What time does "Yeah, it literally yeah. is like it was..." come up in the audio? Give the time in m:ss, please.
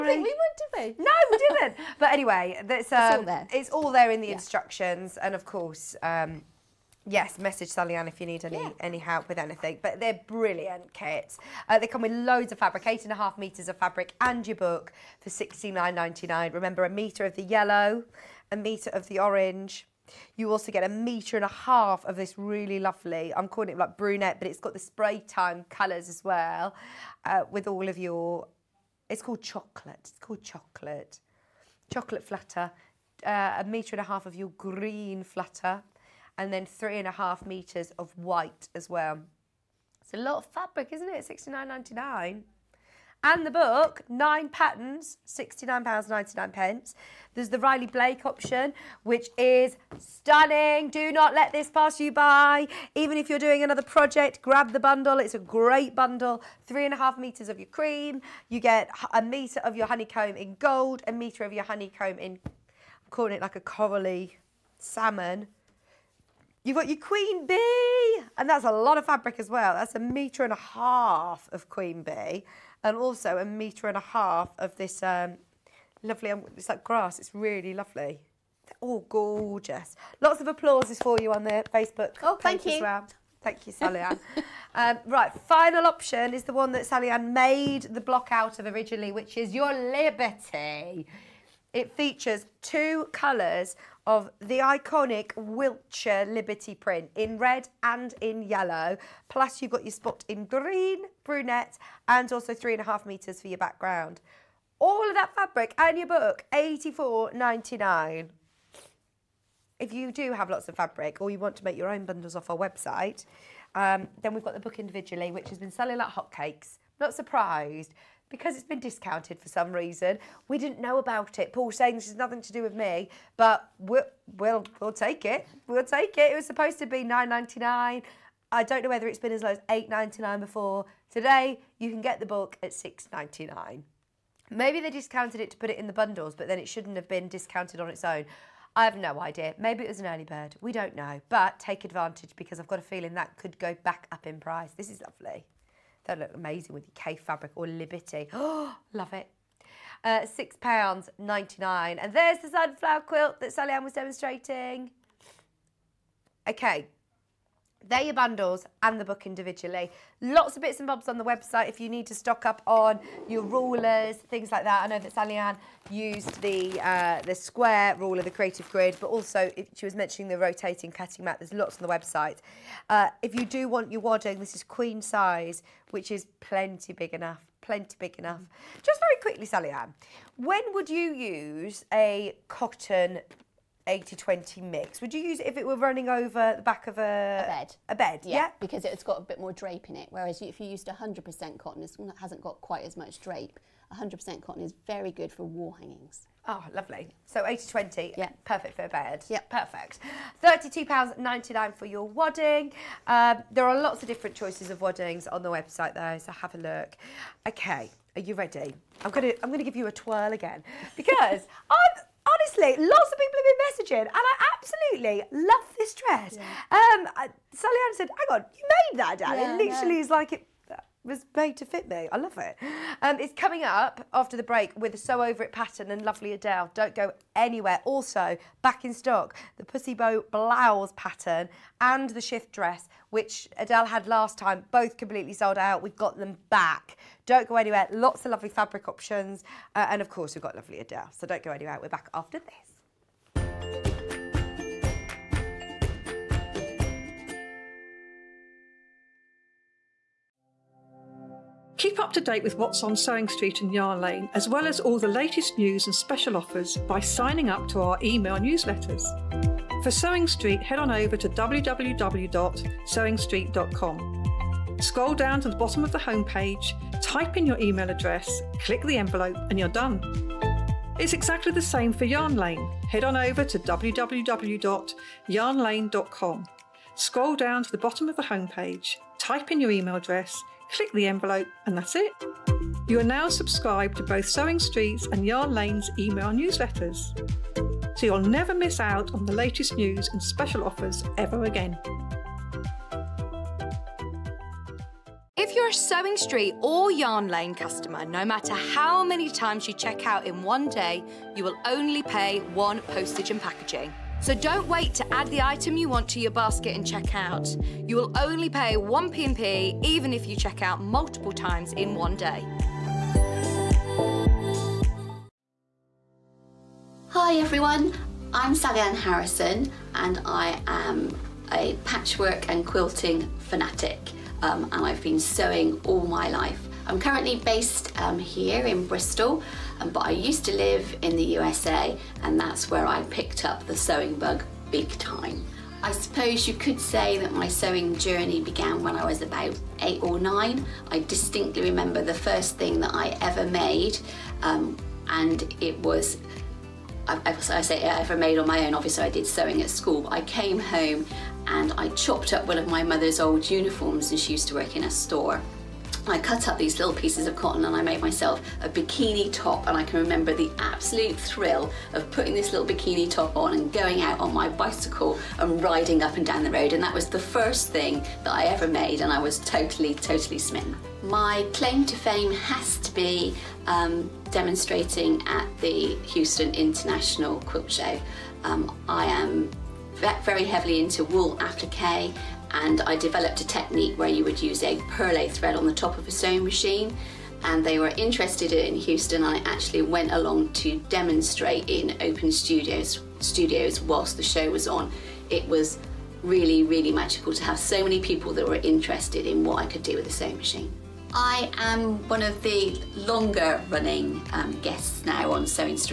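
3:39.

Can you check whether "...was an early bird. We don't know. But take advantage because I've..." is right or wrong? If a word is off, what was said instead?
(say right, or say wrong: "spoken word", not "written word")
right.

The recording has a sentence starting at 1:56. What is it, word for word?
Not surprised because it's been discounted for some reason.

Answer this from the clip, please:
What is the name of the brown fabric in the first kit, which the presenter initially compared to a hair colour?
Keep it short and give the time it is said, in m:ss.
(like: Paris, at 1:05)
Chocolate flutter, at 0:31.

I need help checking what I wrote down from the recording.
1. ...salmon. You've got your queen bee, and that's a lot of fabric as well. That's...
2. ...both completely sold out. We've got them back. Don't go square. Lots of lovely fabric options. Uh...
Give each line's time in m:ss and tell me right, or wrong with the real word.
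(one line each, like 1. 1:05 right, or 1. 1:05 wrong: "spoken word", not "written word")
1. 1:04 right
2. 3:54 wrong: "anywhere", not "square".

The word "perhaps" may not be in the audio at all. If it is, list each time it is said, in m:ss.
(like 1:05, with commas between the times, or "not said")
not said.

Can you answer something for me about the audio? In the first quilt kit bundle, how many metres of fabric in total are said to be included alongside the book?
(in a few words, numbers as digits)
8.5 metres.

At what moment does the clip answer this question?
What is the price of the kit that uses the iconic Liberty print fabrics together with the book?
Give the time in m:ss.
1:46.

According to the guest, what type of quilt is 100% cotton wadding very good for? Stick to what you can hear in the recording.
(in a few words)
Wall hangings.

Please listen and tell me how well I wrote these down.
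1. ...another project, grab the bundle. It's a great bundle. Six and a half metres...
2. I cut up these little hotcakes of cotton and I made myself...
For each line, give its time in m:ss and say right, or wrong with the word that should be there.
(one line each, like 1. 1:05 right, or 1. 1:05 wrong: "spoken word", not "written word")
1. 0:53 wrong: "Three", not "Six"
2. 5:56 wrong: "pieces", not "hotcakes".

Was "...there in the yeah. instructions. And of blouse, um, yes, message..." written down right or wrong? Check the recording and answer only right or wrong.
wrong.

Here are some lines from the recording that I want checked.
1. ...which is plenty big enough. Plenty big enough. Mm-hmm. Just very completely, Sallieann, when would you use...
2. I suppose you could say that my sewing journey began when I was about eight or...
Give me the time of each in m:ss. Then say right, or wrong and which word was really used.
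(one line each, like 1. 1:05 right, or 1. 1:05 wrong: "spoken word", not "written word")
1. 2:55 wrong: "quickly", not "completely"
2. 5:35 right.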